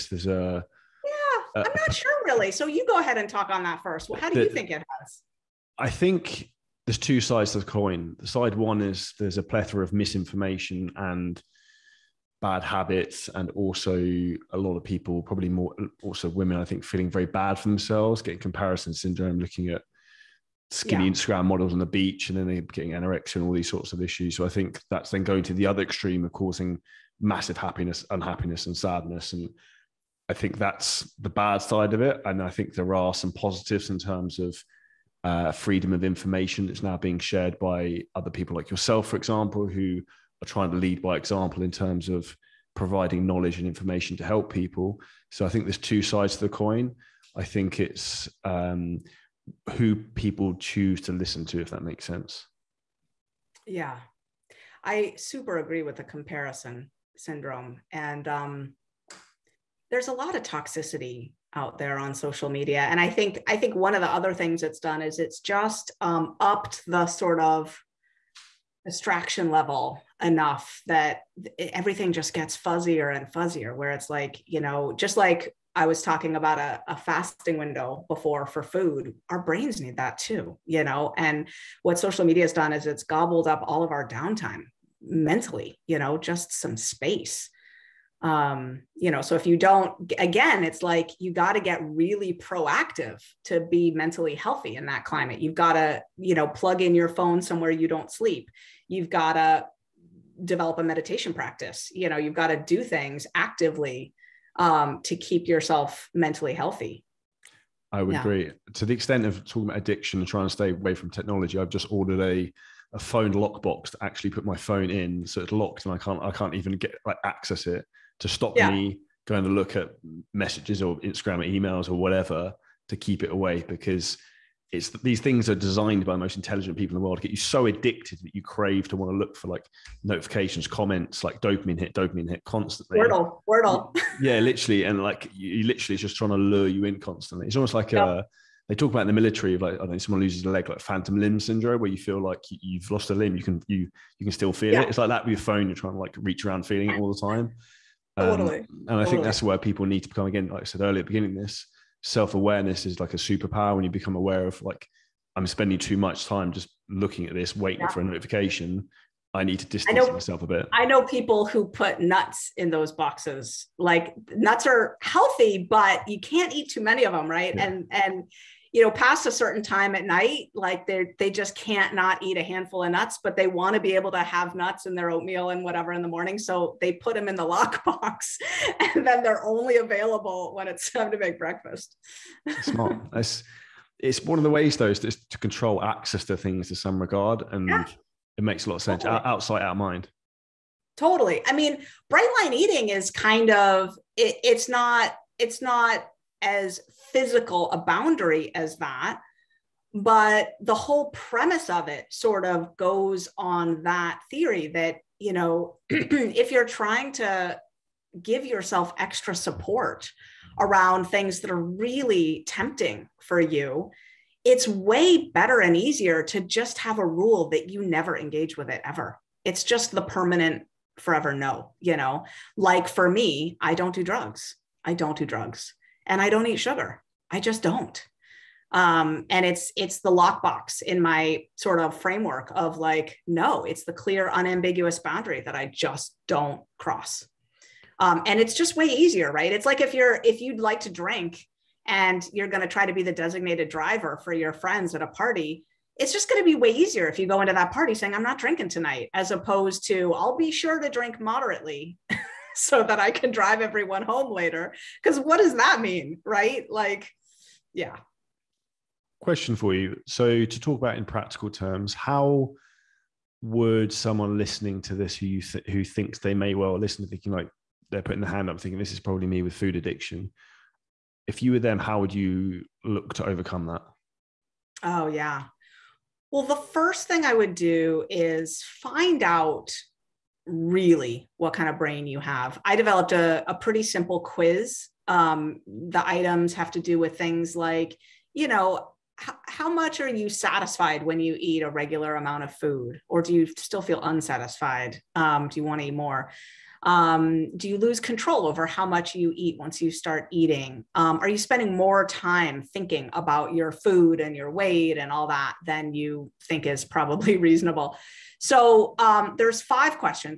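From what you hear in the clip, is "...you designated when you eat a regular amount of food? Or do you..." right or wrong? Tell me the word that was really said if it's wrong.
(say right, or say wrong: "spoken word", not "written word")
wrong: "satisfied", not "designated".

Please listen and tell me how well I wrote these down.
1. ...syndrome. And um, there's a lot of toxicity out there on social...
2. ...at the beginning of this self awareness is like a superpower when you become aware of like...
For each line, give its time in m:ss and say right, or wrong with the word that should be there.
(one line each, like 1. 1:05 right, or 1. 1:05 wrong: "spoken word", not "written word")
1. 0:57 right
2. 2:31 right.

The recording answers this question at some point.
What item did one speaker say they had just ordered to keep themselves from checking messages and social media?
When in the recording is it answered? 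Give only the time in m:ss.
1:52.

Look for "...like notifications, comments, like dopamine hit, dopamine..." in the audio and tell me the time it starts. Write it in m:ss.
2:09.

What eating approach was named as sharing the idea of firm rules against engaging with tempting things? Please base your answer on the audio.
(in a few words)
bright line eating.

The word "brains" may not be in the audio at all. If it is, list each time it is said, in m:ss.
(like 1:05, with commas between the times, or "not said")
1:19, 4:41.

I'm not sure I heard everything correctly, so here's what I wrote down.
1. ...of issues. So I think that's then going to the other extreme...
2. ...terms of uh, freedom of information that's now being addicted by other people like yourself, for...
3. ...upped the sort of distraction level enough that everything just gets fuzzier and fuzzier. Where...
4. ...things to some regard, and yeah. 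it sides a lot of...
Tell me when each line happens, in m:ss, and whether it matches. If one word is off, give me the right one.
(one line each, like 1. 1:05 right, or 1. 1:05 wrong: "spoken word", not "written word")
1. 0:23 right
2. 0:33 wrong: "shared", not "addicted"
3. 1:06 right
4. 3:06 wrong: "makes", not "sides".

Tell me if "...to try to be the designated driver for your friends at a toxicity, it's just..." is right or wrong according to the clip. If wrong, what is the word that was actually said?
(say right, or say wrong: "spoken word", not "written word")
wrong: "party", not "toxicity".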